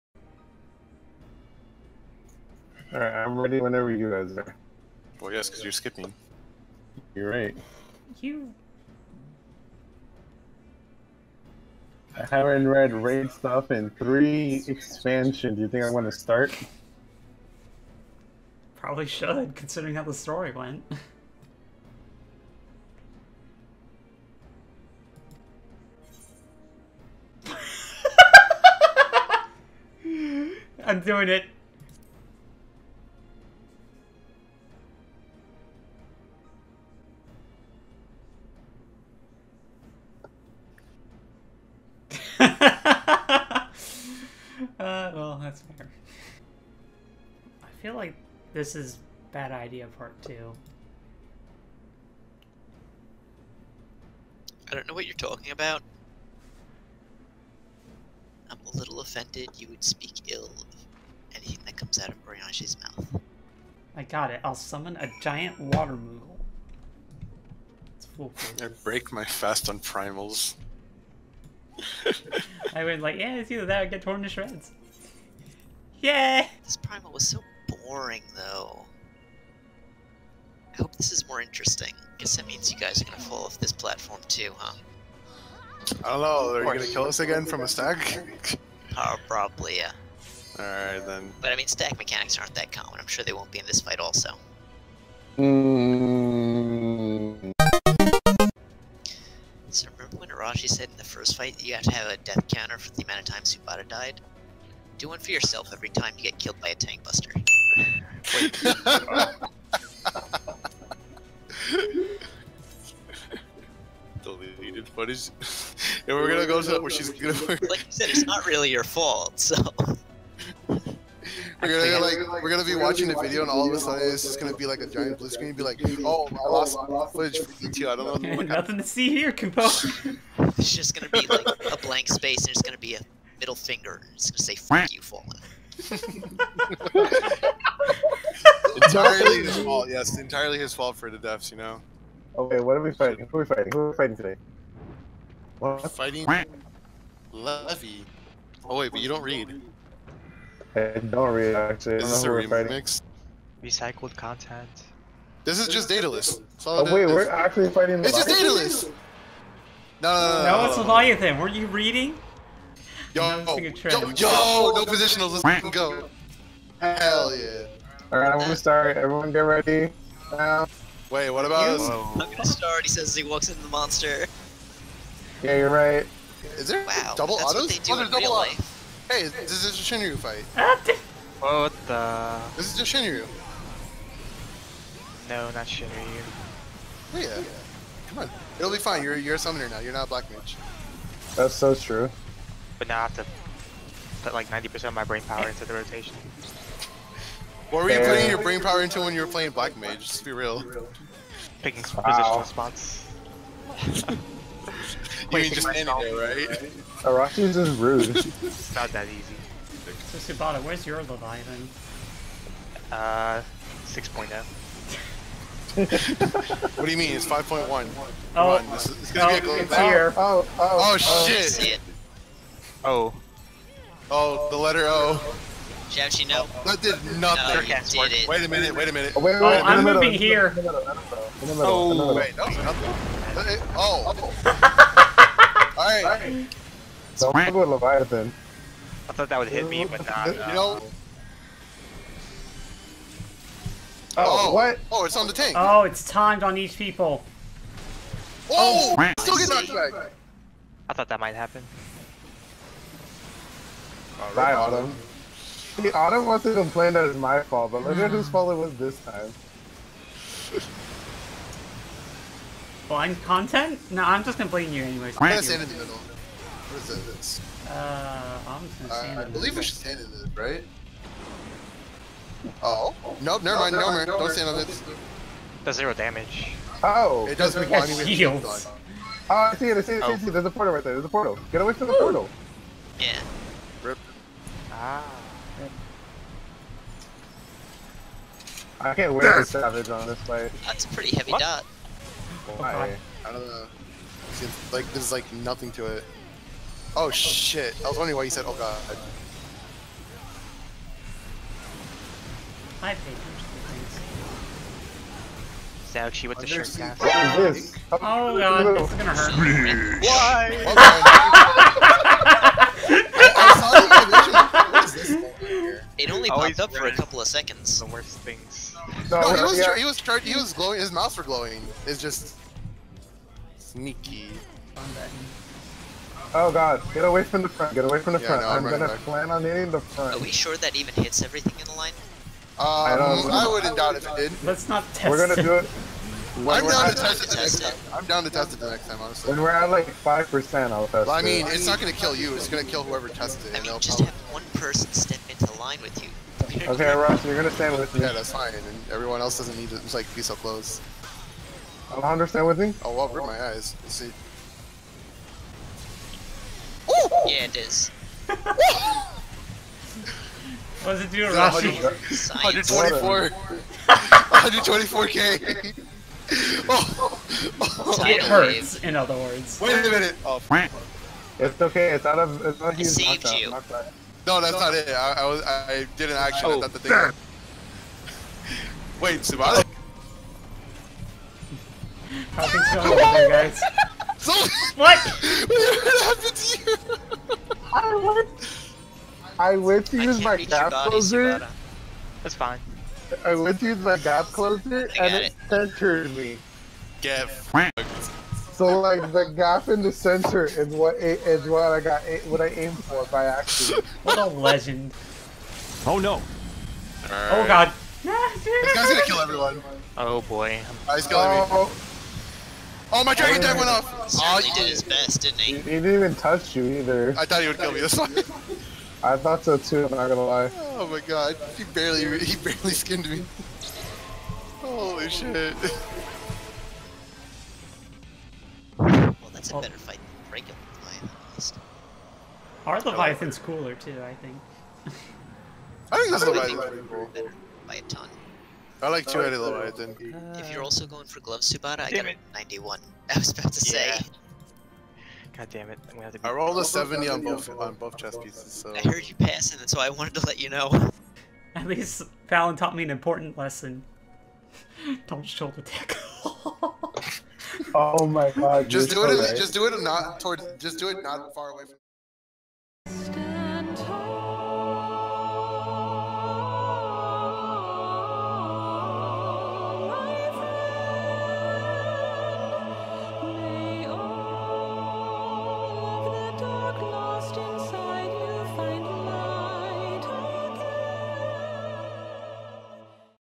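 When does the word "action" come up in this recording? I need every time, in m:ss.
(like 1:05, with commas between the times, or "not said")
6:16.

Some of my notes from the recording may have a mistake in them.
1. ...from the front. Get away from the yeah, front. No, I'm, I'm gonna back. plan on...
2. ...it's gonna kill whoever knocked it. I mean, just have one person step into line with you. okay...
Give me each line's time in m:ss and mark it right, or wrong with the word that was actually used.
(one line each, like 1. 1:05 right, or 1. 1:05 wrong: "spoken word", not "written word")
1. 5:27 right
2. 5:42 wrong: "tested", not "knocked".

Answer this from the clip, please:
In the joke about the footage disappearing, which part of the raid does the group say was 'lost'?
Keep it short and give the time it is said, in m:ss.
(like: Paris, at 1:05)
E2, at 2:07.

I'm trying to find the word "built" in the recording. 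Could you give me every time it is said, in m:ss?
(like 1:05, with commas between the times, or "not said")
not said.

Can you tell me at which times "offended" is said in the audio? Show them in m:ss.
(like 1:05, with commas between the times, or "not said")
0:58.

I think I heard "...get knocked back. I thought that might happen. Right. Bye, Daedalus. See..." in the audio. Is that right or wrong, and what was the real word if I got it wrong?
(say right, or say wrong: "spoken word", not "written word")
wrong: "Autumn", not "Daedalus".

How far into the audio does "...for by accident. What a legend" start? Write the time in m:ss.
6:42.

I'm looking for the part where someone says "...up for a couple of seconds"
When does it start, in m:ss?
5:16.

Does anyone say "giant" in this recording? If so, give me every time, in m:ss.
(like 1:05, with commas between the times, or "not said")
1:05, 2:04.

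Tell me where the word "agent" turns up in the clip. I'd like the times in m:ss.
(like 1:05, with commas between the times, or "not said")
not said.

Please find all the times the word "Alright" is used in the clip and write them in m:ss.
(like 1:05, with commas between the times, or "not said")
1:30, 2:48, 3:55.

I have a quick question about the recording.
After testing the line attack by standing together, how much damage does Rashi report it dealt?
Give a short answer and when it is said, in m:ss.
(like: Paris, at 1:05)
124k, at 6:04.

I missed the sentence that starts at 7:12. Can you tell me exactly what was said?
Our Leviathan's cooler, too, I think.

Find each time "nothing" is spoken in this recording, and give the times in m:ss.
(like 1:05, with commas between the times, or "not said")
2:08, 3:47, 3:52, 4:55.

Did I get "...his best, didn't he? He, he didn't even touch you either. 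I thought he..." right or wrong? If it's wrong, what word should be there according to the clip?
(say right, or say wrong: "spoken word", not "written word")
right.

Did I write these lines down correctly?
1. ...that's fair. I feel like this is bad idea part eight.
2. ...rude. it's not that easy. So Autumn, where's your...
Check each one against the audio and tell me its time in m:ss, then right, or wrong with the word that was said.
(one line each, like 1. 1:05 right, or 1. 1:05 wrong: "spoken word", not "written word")
1. 0:45 wrong: "two", not "eight"
2. 3:27 wrong: "Tsubata", not "Autumn".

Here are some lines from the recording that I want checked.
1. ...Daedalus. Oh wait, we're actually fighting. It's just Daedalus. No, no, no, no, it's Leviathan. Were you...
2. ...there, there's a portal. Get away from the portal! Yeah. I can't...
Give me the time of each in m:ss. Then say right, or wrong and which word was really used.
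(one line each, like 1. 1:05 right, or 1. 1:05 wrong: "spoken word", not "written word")
1. 2:35 right
2. 4:40 right.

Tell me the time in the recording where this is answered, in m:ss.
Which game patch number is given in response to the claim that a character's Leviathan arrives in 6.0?
3:37.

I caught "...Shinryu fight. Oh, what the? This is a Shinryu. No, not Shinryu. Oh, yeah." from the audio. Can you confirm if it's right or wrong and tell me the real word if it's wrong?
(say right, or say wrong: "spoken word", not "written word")
right.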